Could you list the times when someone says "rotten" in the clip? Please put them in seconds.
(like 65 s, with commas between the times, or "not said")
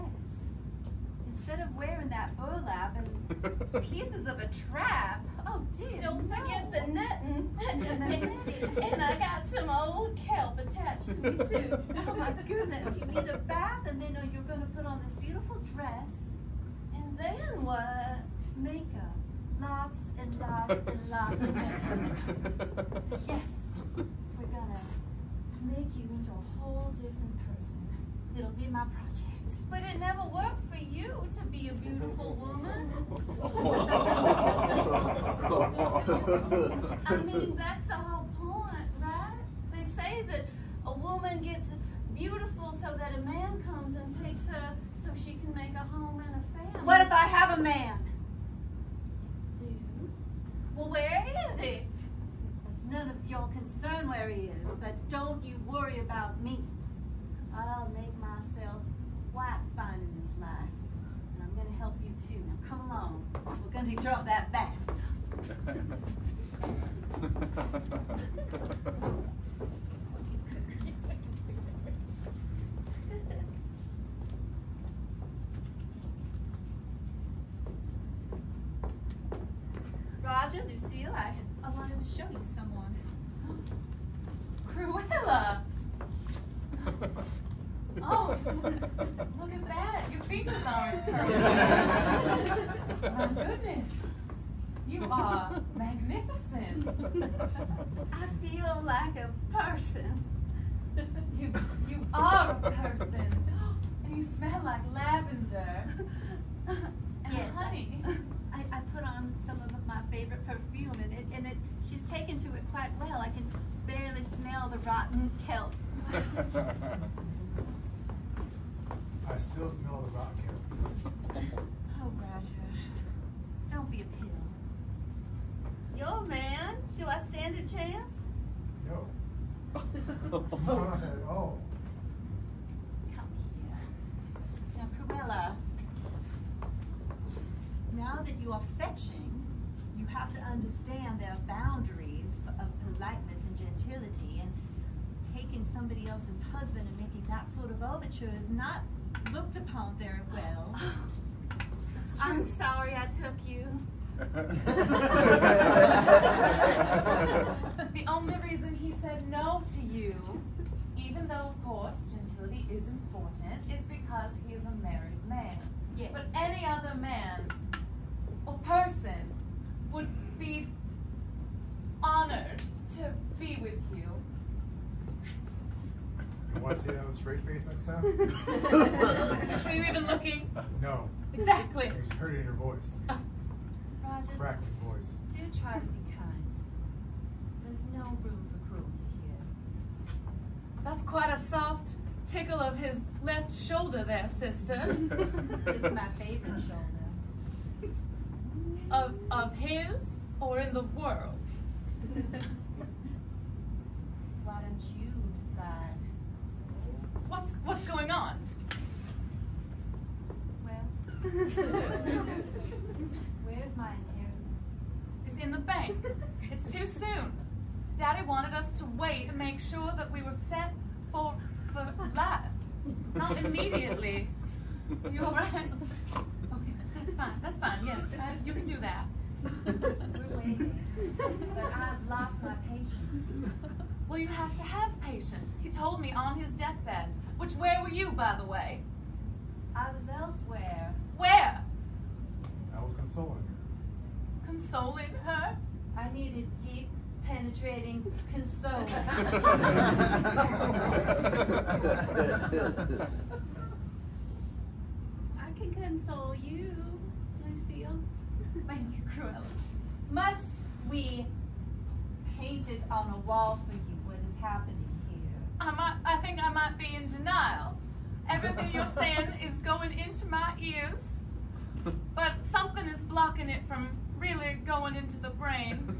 114 s, 120 s.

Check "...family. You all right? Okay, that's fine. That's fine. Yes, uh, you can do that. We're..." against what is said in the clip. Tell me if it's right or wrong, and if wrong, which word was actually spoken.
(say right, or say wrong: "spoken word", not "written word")
wrong: "immediately", not "family".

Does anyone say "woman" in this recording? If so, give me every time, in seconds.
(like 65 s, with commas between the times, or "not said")
32 s, 40 s.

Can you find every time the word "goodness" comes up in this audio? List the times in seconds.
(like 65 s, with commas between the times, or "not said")
12 s, 93 s.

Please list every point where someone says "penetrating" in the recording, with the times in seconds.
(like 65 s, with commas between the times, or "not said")
247 s.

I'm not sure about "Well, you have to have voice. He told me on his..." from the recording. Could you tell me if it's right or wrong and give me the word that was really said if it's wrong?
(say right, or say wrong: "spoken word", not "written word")
wrong: "patience", not "voice".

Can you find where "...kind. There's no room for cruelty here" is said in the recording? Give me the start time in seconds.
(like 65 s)
186 s.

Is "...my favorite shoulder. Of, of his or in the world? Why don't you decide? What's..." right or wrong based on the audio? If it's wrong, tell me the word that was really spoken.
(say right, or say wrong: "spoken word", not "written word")
right.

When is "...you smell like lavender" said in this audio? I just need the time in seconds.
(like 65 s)
104 s.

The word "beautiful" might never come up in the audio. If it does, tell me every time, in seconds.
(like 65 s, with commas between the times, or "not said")
15 s, 31 s, 42 s.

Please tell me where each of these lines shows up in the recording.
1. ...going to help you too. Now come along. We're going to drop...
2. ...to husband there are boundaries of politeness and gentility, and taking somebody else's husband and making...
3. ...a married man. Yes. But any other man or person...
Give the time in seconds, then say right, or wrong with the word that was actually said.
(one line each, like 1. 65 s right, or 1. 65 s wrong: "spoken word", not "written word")
1. 61 s right
2. 140 s wrong: "understand", not "husband"
3. 164 s right.